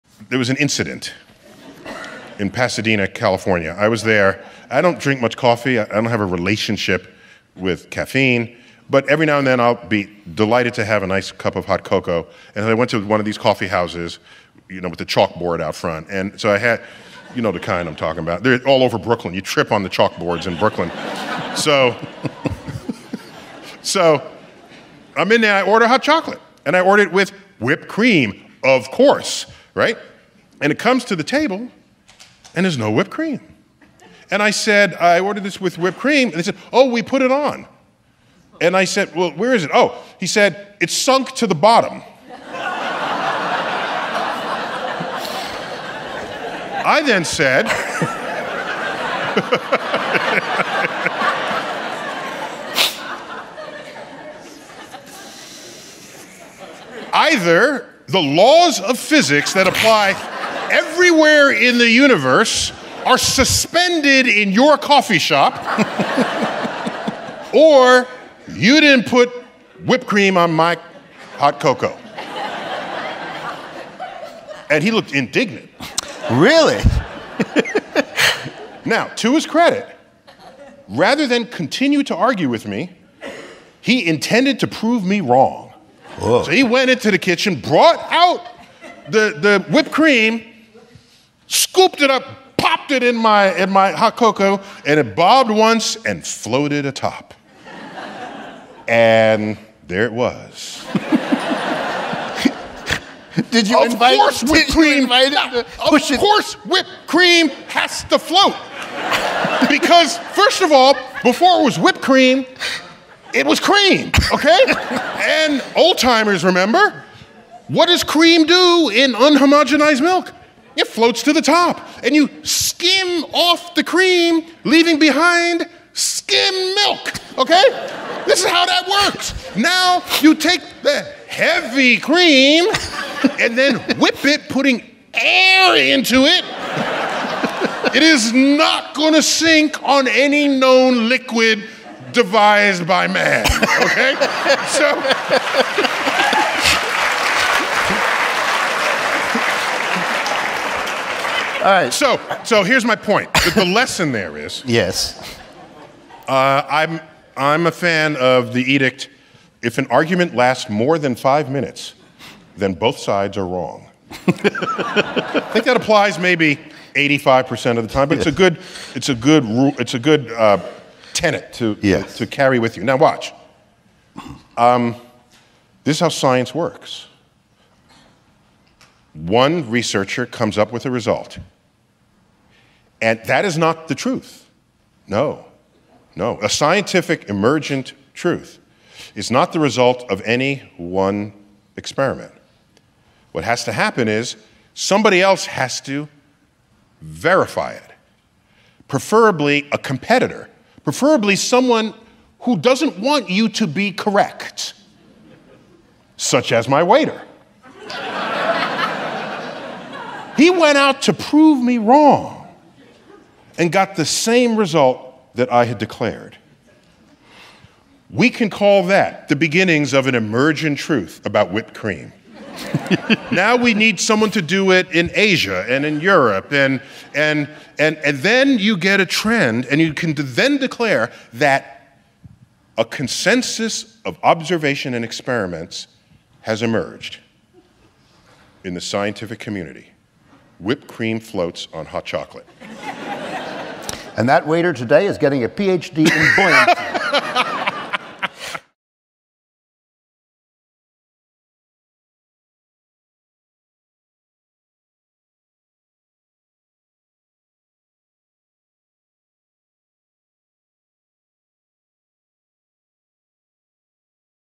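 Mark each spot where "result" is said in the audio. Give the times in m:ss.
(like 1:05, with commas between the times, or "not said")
3:00, 3:09, 3:34.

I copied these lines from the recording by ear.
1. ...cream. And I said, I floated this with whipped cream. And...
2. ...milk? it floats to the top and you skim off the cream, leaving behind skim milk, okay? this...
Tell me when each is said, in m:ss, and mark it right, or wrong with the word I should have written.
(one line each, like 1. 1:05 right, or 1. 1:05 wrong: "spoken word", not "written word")
1. 0:33 wrong: "ordered", not "floated"
2. 2:00 right.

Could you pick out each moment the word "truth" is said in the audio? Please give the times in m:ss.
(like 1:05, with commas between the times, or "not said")
3:03, 3:08, 3:40.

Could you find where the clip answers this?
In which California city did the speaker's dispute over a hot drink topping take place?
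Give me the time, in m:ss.
0:02.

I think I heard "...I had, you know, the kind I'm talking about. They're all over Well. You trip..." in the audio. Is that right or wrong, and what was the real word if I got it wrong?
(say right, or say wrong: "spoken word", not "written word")
wrong: "Brooklyn", not "Well".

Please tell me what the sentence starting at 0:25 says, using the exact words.
I order hot chocolate, and I order it with whipped cream, of course, right?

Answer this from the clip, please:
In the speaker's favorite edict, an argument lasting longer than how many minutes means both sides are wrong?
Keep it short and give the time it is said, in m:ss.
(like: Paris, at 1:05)
5, at 2:41.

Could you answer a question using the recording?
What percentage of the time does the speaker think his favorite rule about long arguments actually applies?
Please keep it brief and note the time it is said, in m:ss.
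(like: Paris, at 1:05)
85%, at 2:46.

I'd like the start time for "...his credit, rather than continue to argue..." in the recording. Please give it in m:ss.
1:19.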